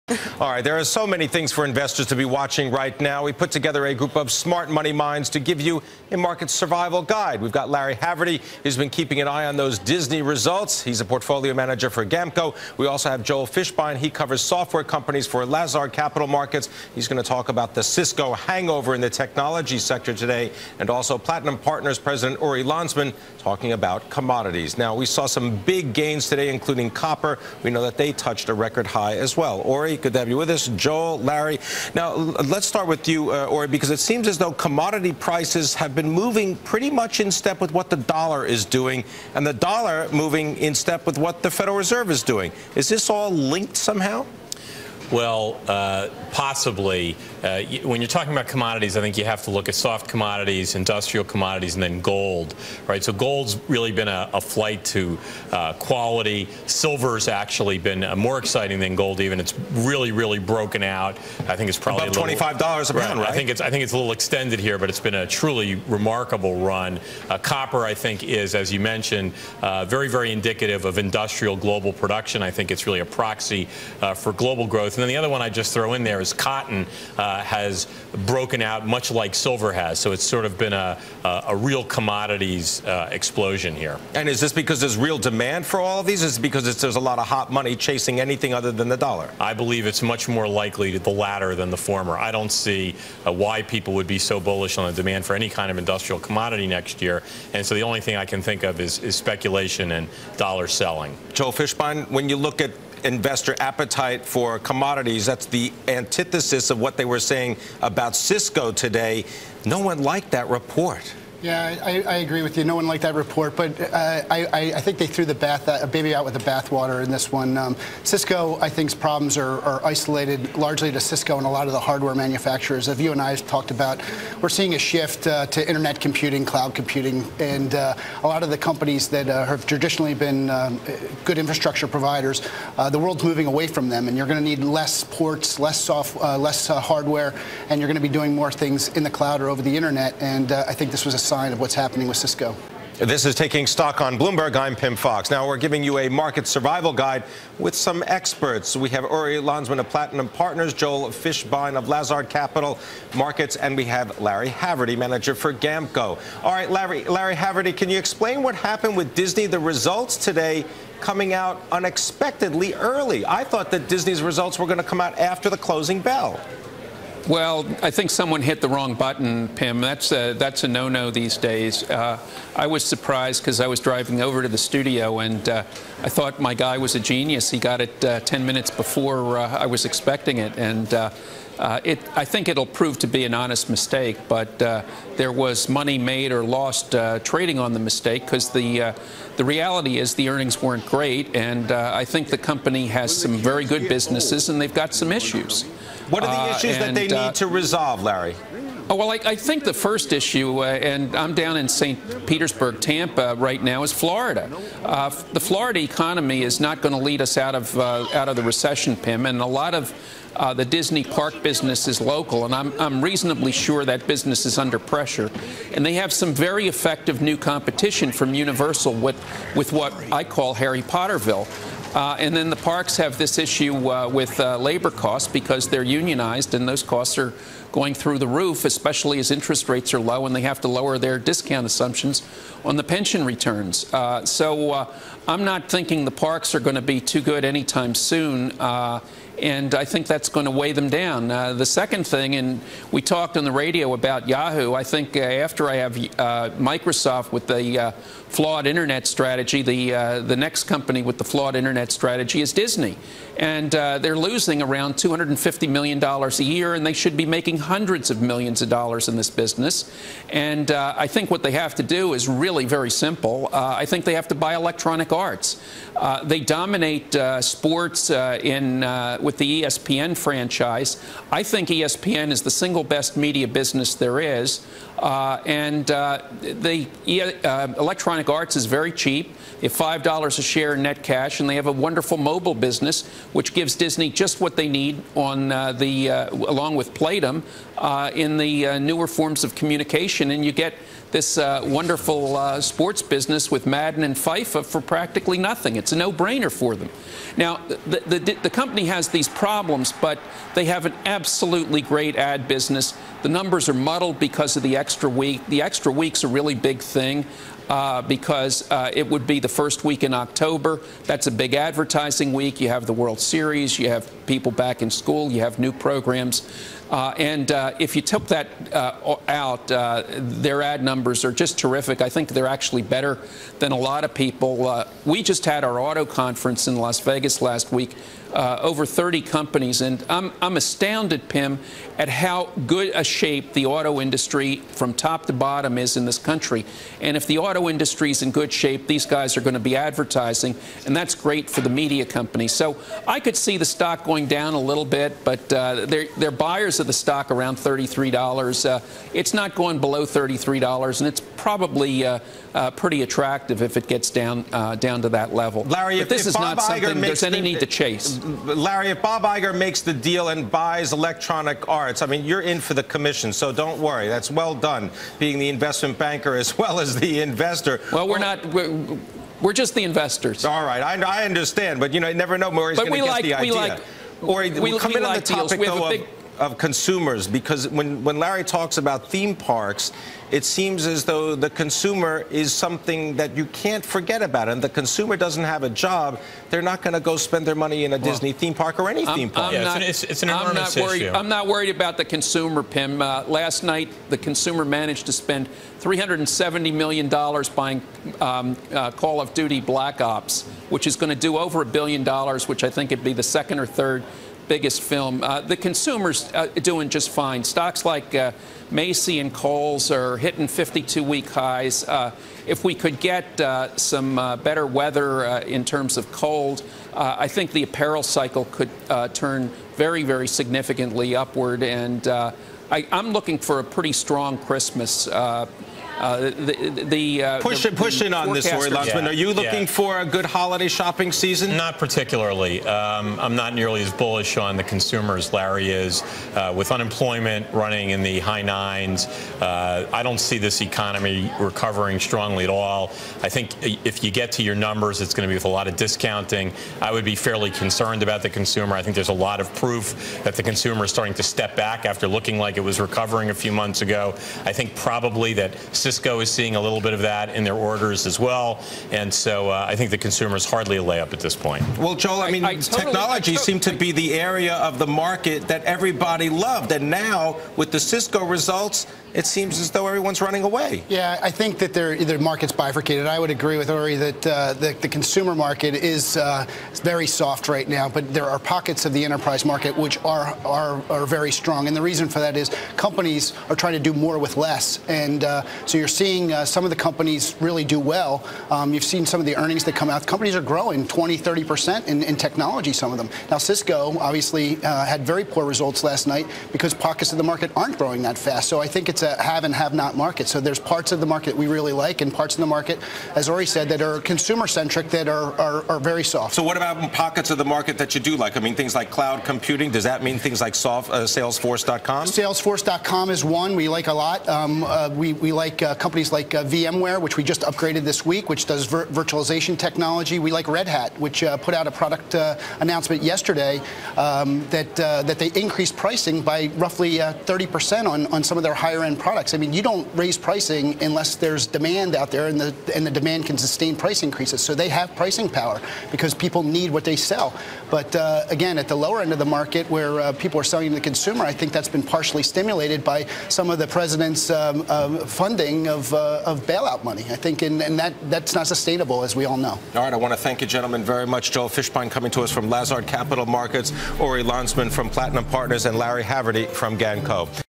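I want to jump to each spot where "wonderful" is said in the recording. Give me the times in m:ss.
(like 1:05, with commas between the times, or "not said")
4:41, 4:51.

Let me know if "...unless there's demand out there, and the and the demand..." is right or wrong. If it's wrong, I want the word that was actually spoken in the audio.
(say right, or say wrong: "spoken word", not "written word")
right.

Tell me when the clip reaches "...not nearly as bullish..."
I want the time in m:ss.
7:13.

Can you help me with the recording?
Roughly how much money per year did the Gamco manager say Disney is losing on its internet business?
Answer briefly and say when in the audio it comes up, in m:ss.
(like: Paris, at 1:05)
$250 million, at 4:14.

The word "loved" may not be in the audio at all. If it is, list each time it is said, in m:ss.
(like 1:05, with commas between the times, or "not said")
7:46.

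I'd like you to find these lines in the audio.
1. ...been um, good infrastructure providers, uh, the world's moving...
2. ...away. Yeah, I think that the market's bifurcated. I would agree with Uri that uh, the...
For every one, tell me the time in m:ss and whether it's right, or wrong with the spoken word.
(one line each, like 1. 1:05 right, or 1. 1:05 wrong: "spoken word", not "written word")
1. 2:10 right
2. 7:50 right.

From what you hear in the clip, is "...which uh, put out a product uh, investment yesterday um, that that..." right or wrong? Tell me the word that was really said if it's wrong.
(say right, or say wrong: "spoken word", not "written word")
wrong: "announcement", not "investment".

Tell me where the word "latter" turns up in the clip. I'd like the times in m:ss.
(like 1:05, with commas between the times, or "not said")
1:31.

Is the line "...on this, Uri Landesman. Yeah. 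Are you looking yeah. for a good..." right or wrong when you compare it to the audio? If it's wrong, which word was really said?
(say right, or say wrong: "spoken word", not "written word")
right.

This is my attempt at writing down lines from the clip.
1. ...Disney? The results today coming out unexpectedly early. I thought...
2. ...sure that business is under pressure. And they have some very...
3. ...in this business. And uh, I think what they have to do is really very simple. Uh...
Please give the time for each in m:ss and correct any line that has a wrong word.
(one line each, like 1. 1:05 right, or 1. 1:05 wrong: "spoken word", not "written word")
1. 2:39 right
2. 3:33 right
3. 4:19 right.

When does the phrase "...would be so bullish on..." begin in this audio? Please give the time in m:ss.
1:33.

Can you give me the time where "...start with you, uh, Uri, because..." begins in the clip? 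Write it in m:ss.
0:32.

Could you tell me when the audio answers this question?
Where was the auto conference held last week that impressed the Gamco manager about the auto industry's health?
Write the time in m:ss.
5:26.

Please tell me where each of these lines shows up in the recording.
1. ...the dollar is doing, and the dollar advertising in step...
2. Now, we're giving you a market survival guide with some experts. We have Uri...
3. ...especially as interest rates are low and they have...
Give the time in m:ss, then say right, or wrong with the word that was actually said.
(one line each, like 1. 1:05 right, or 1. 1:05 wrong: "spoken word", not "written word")
1. 0:37 wrong: "moving", not "advertising"
2. 2:25 right
3. 3:48 right.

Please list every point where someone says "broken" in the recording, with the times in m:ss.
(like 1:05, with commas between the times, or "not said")
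1:00, 1:18.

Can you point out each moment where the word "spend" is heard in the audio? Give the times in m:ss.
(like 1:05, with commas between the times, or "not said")
6:27, 6:35.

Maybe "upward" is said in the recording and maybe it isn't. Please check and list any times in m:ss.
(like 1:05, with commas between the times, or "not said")
7:01.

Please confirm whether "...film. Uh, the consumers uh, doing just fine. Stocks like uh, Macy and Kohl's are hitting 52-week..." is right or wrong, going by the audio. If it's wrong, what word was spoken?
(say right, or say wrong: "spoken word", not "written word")
right.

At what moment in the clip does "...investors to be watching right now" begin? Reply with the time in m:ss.
0:01.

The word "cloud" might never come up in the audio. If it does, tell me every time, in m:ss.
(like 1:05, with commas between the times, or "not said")
2:06, 2:19, 8:28.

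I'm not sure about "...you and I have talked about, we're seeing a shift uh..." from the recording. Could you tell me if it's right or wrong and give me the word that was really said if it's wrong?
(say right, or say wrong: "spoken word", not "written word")
right.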